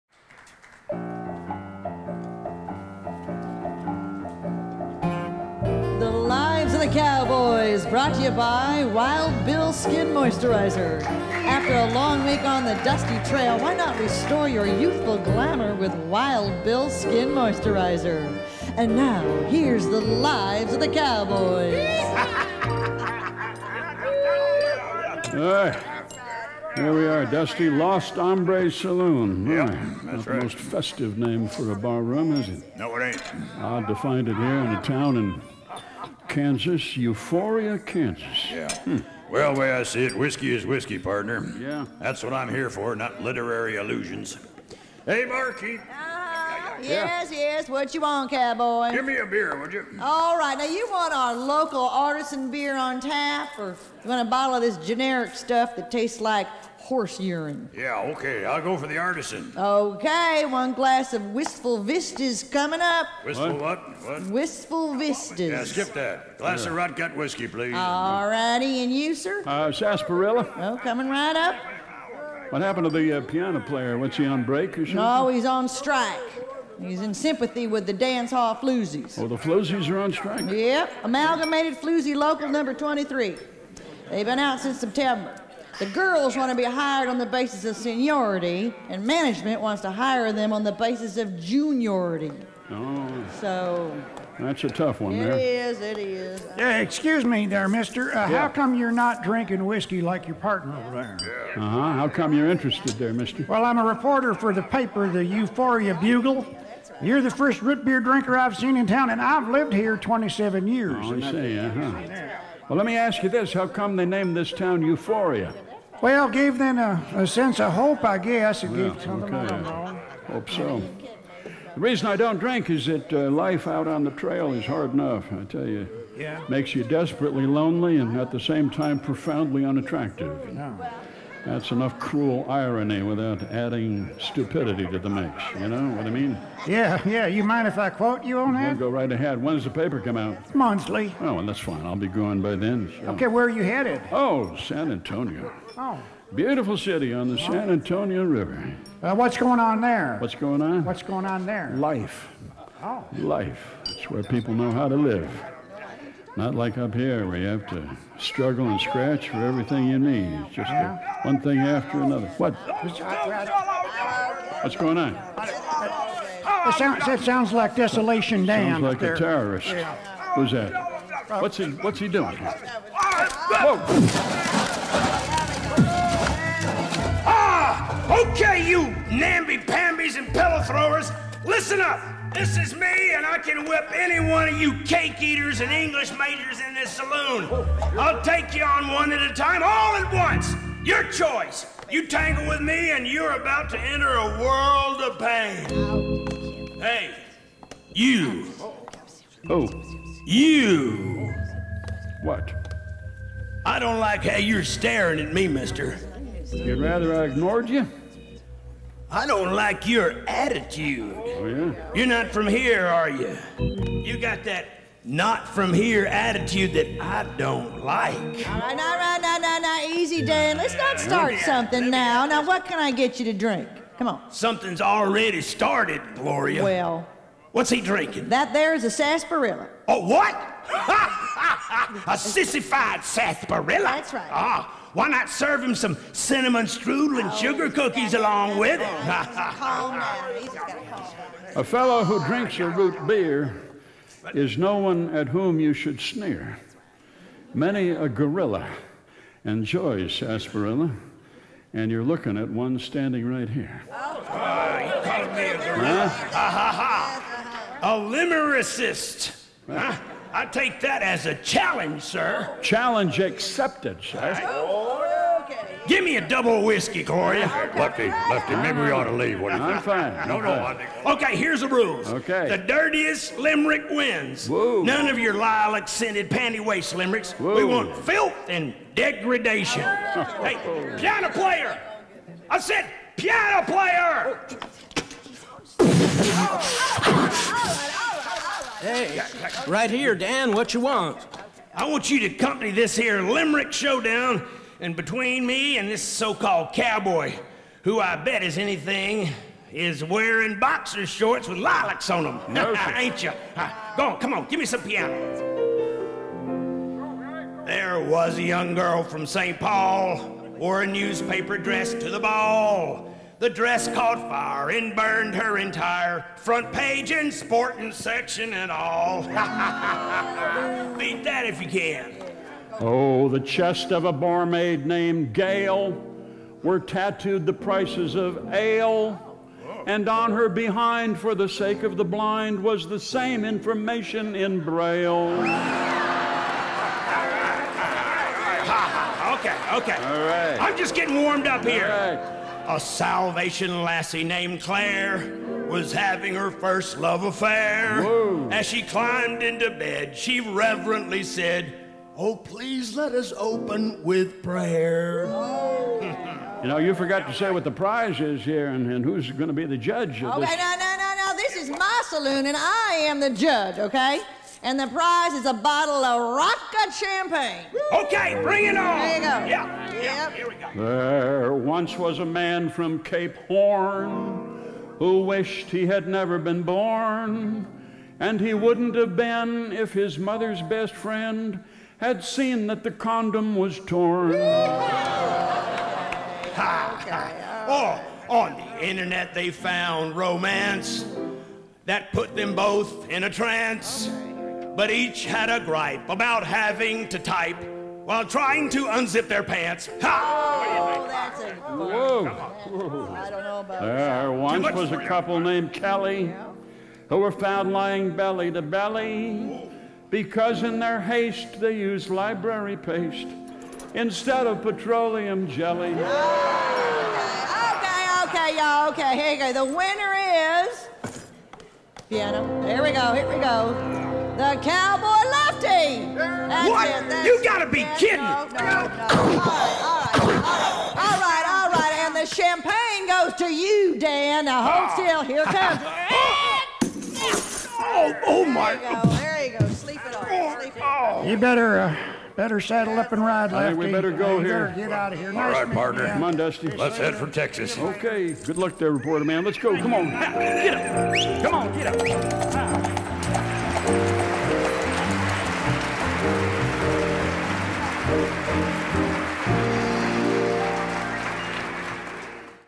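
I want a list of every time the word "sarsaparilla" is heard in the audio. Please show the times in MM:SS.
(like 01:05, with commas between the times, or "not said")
01:09, 03:48, 03:53, 04:10.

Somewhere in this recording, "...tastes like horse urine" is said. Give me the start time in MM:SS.
00:55.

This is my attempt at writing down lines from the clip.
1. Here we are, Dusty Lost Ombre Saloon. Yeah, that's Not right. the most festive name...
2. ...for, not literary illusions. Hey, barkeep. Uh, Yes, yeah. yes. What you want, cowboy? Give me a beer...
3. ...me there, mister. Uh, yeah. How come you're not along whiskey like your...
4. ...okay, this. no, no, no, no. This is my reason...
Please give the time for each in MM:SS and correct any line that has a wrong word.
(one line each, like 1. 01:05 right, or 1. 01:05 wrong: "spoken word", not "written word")
1. 00:26 right
2. 00:42 right
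3. 01:37 wrong: "drinking", not "along"
4. 06:00 wrong: "saloon", not "reason".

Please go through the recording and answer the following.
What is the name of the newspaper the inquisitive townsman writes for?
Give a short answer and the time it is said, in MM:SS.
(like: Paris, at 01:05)
Euphoria Bugle, at 01:45.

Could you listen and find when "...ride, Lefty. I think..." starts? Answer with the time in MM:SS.
07:23.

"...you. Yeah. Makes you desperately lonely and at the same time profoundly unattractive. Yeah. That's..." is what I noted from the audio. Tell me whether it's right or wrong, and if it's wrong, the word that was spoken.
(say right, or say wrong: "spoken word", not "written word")
right.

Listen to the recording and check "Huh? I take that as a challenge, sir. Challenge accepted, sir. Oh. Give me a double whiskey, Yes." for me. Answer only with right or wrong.
wrong.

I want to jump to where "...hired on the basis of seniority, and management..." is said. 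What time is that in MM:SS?
01:26.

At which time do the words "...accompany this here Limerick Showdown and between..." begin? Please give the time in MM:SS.
04:52.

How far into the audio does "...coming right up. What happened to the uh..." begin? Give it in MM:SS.
01:10.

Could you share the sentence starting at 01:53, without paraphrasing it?
How come they named this town Euphoria?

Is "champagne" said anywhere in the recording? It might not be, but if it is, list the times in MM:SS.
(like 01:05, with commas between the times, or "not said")
06:06, 07:12.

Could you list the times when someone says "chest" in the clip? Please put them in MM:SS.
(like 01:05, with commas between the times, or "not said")
05:23.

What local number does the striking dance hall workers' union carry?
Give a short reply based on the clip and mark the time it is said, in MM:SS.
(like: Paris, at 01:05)
23, at 01:22.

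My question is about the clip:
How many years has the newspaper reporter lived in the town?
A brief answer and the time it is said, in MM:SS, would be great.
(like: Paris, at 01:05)
27, at 01:49.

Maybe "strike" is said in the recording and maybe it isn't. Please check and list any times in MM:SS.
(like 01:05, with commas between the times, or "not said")
01:15, 01:20.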